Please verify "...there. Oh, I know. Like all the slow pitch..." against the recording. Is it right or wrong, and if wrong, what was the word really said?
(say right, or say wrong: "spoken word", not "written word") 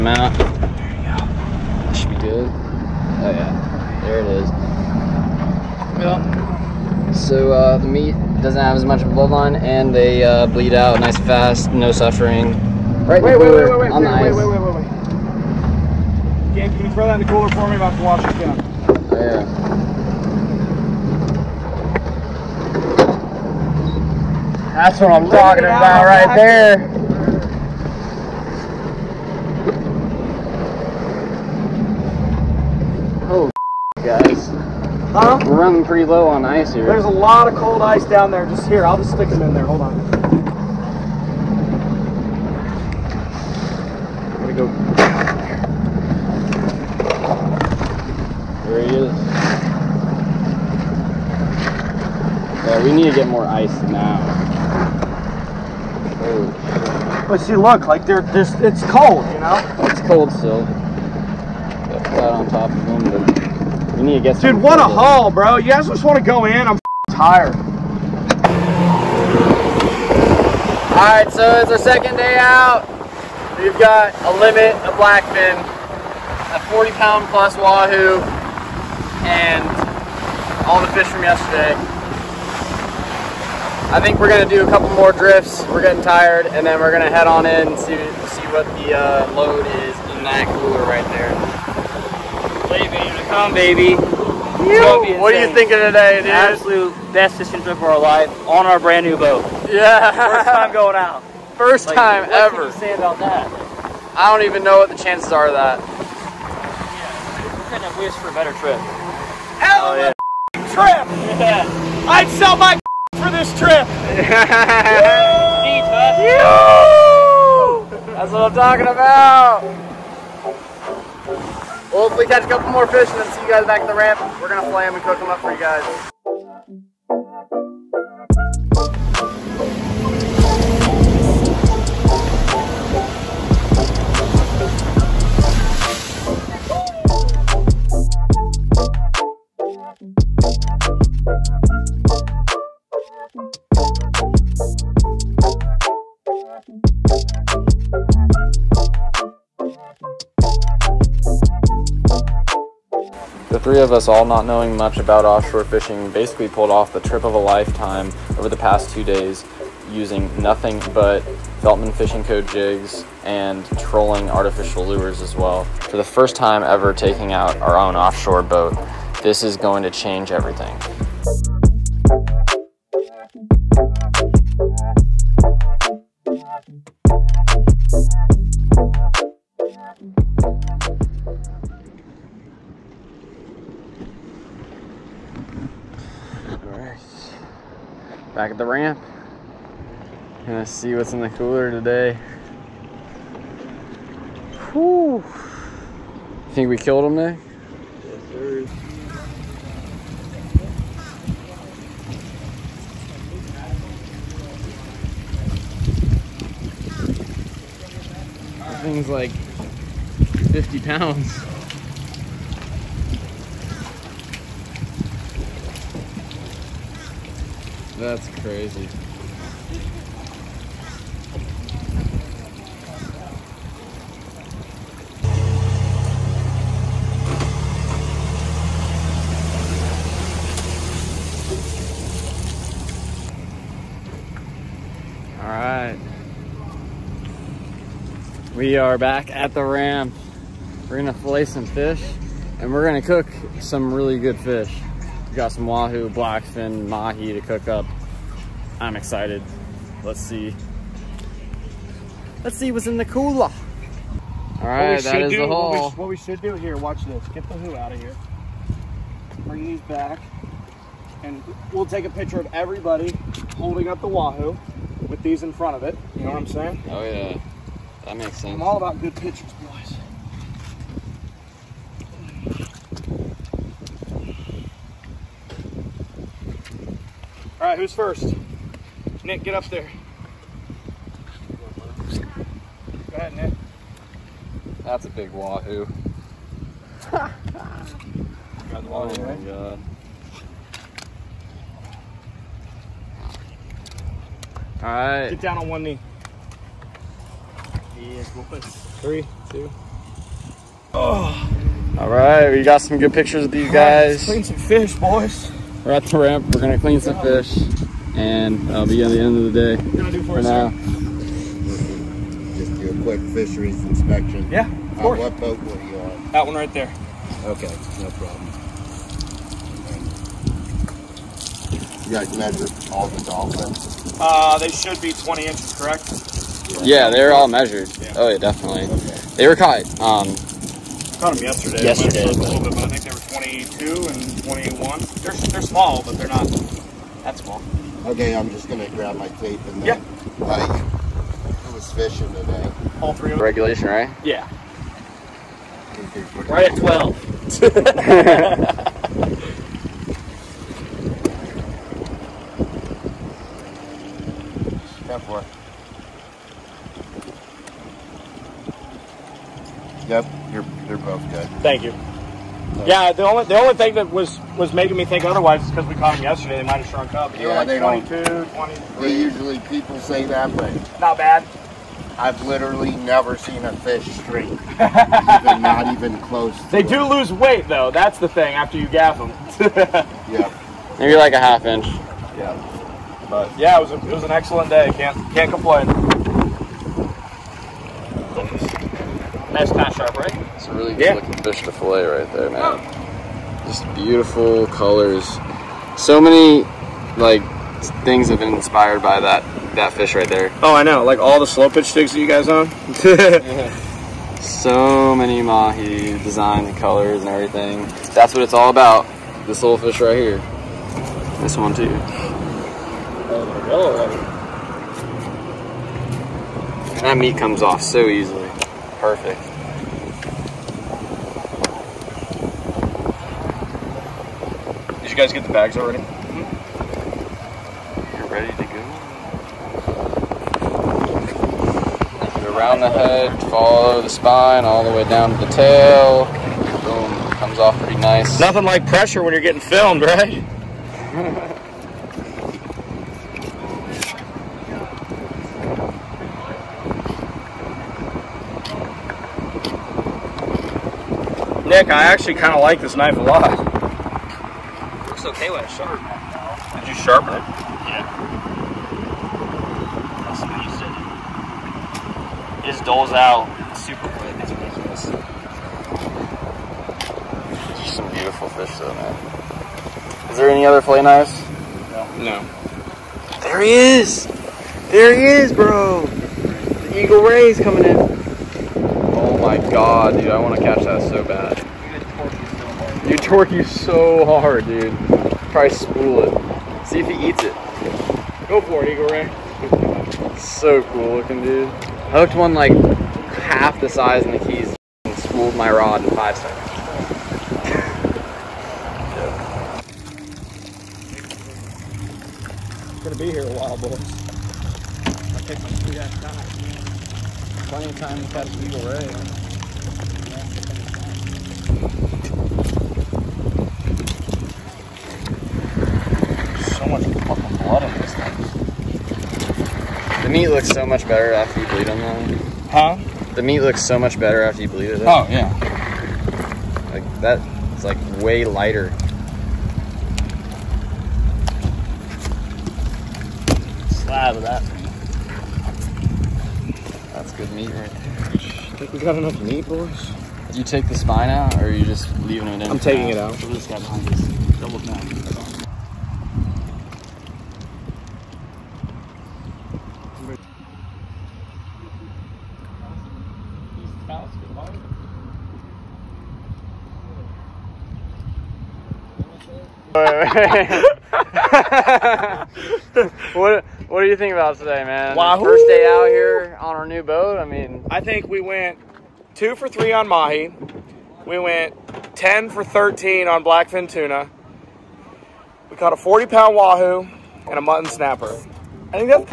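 right.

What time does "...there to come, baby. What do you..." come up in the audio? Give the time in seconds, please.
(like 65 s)
91 s.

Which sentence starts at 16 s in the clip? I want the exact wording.
Gabe, can you throw that in the cooler for me?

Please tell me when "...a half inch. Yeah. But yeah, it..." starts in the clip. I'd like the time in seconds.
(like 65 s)
381 s.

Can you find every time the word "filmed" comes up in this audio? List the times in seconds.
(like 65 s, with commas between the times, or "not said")
439 s.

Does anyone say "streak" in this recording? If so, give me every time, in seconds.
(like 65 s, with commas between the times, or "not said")
374 s.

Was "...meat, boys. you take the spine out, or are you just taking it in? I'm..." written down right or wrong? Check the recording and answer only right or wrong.
wrong.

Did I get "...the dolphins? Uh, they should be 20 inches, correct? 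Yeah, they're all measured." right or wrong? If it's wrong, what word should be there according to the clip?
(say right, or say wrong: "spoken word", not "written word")
right.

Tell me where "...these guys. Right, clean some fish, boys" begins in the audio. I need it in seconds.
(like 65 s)
303 s.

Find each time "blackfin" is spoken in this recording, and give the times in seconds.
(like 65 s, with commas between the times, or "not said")
74 s, 246 s, 573 s.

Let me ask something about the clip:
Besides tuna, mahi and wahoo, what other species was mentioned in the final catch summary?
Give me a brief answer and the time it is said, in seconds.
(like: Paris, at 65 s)
mutton snapper, at 577 s.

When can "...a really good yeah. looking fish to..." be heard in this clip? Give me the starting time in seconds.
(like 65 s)
390 s.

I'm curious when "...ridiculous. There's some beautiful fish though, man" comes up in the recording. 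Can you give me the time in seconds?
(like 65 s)
464 s.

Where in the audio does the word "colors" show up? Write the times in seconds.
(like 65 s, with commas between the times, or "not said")
394 s, 406 s.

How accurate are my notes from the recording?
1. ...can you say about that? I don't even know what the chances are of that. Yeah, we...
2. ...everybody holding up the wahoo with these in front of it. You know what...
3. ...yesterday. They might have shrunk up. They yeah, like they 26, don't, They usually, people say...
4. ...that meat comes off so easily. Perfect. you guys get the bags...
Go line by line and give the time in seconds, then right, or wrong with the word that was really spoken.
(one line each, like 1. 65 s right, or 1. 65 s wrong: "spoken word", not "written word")
1. 102 s right
2. 262 s right
3. 366 s wrong: "22", not "26"
4. 417 s right.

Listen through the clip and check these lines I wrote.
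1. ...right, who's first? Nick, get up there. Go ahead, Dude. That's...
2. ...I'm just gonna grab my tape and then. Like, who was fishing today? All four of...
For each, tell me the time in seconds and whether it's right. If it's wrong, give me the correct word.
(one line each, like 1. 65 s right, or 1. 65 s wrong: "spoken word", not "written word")
1. 277 s wrong: "Nick", not "Dude"
2. 338 s wrong: "three", not "four".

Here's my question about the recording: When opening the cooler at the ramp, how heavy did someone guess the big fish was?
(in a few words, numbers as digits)
50 pounds.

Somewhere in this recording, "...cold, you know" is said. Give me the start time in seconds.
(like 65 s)
58 s.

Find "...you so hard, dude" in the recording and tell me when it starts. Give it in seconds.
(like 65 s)
483 s.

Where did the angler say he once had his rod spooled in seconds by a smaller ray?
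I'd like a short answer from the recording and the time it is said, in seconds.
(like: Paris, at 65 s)
the Keys, at 494 s.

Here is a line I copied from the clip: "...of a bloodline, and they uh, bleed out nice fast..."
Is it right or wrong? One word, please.
right.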